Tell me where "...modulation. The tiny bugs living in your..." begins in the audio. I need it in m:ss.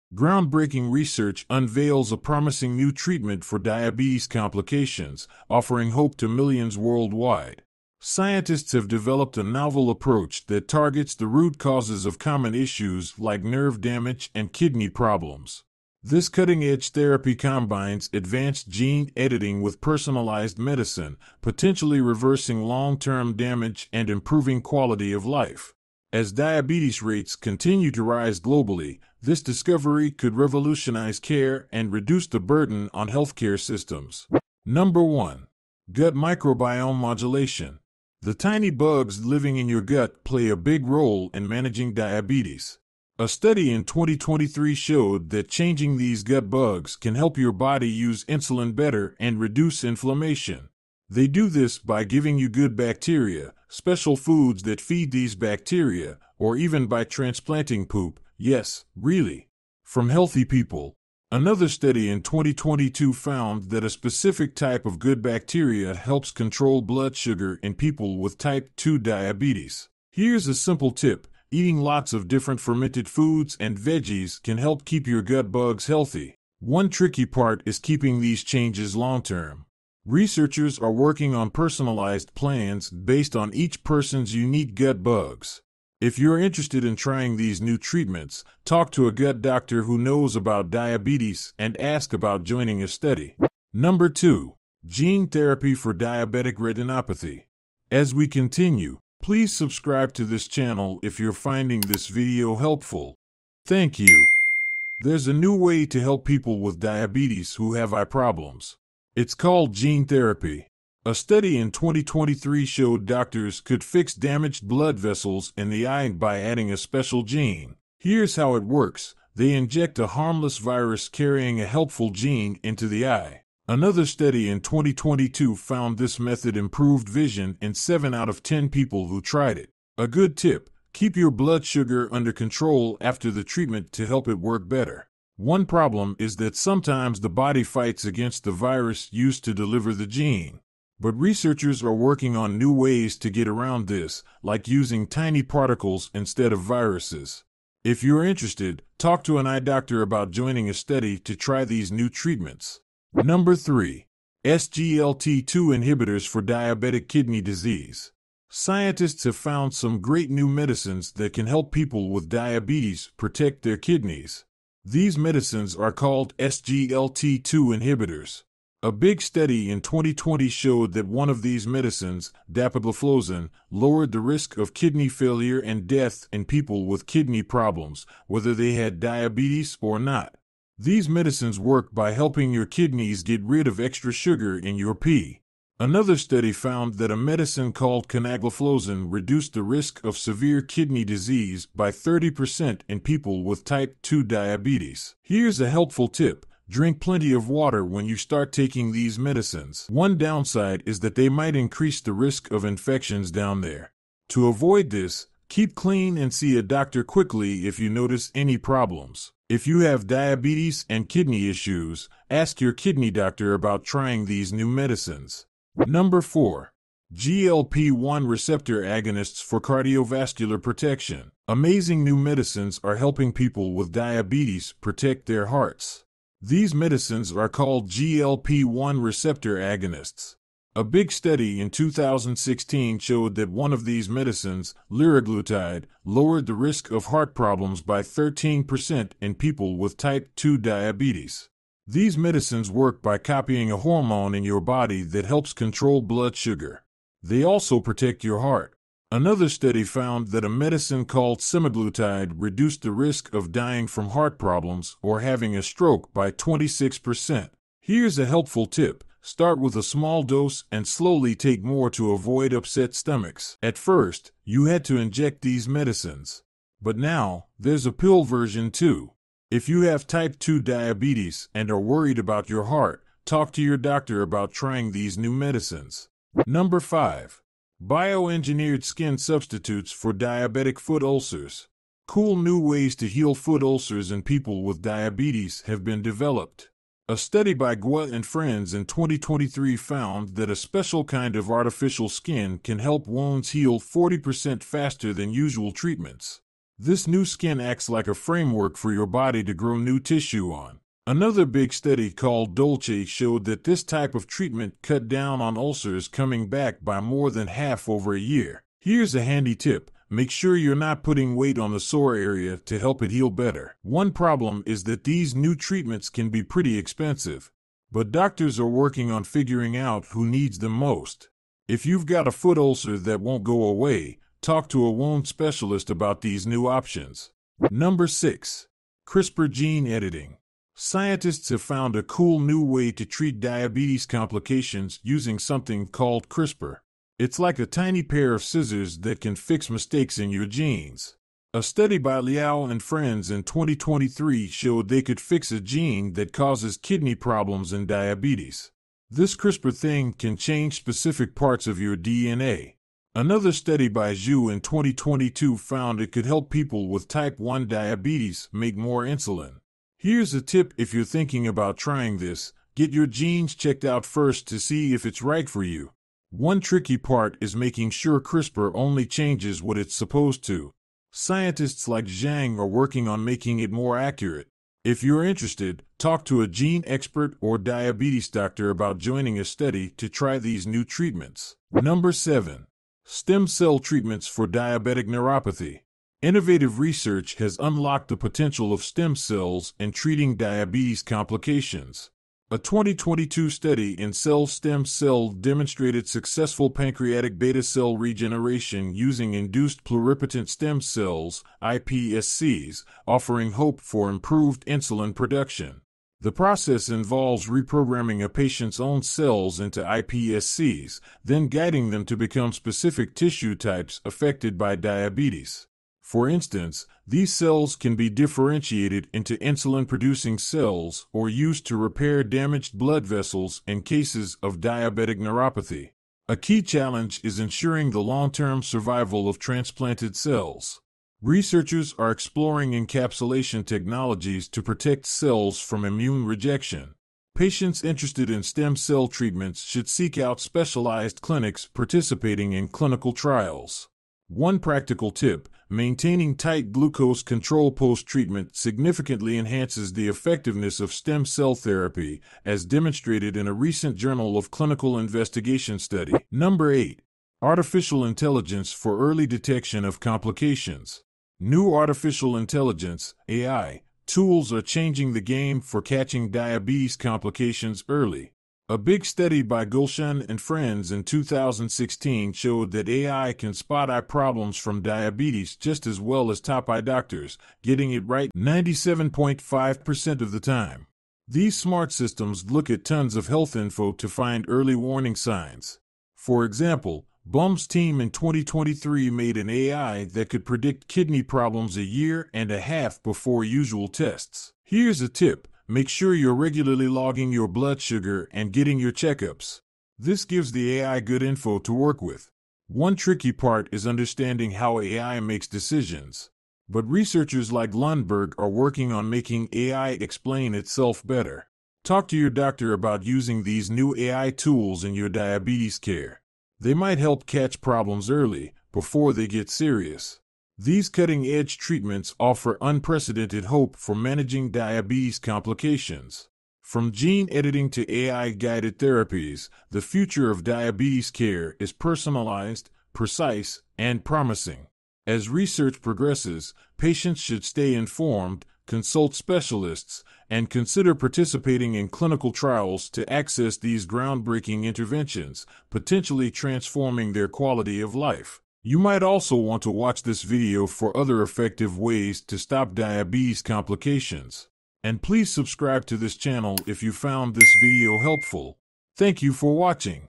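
0:36.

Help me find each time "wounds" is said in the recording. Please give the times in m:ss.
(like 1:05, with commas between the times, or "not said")
4:53, 5:24.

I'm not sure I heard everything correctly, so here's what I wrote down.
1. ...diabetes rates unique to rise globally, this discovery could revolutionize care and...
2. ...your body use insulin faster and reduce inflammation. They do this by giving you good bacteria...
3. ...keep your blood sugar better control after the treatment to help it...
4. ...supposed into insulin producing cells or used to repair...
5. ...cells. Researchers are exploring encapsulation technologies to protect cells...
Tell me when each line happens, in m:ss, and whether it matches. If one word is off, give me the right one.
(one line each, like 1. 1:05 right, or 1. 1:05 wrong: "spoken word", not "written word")
1. 0:26 wrong: "continue", not "unique"
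2. 0:47 wrong: "better", not "faster"
3. 2:10 wrong: "under", not "better"
4. 6:58 wrong: "differentiated", not "supposed"
5. 7:10 right.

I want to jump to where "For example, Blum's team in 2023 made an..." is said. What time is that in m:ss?
8:06.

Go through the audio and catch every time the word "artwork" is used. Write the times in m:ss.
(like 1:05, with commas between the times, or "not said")
not said.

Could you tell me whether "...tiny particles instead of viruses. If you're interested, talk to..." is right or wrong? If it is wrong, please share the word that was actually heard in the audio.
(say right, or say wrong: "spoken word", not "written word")
right.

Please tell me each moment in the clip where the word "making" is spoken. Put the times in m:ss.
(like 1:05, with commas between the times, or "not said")
6:07, 6:13, 8:29.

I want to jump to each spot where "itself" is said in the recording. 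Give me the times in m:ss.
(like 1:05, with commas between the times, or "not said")
8:30.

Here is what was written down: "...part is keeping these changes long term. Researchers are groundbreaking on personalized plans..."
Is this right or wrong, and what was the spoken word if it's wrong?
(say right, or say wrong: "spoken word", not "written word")
wrong: "working", not "groundbreaking".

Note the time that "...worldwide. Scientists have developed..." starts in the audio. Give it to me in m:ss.
0:06.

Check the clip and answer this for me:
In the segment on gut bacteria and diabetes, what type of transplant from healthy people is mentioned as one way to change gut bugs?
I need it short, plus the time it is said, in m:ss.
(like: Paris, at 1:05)
Poop, at 0:57.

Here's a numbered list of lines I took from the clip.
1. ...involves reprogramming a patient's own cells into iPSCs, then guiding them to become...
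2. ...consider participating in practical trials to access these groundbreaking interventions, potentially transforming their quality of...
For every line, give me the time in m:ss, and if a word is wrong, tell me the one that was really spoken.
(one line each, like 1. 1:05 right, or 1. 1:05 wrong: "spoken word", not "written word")
1. 6:46 right
2. 9:00 wrong: "clinical", not "practical".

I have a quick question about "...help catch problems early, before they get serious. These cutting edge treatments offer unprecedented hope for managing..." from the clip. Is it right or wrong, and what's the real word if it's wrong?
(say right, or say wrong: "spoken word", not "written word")
right.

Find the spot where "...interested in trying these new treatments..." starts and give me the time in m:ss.
1:26.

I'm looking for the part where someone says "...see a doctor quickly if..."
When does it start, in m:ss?
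3:26.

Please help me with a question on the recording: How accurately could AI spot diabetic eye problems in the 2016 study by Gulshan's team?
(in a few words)
97.5%.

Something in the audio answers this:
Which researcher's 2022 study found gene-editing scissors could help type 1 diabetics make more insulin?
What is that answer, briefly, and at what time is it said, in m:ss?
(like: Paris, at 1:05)
Zhu, at 5:54.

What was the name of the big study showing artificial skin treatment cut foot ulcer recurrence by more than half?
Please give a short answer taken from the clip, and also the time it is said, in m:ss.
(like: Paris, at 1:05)
Dolce, at 5:02.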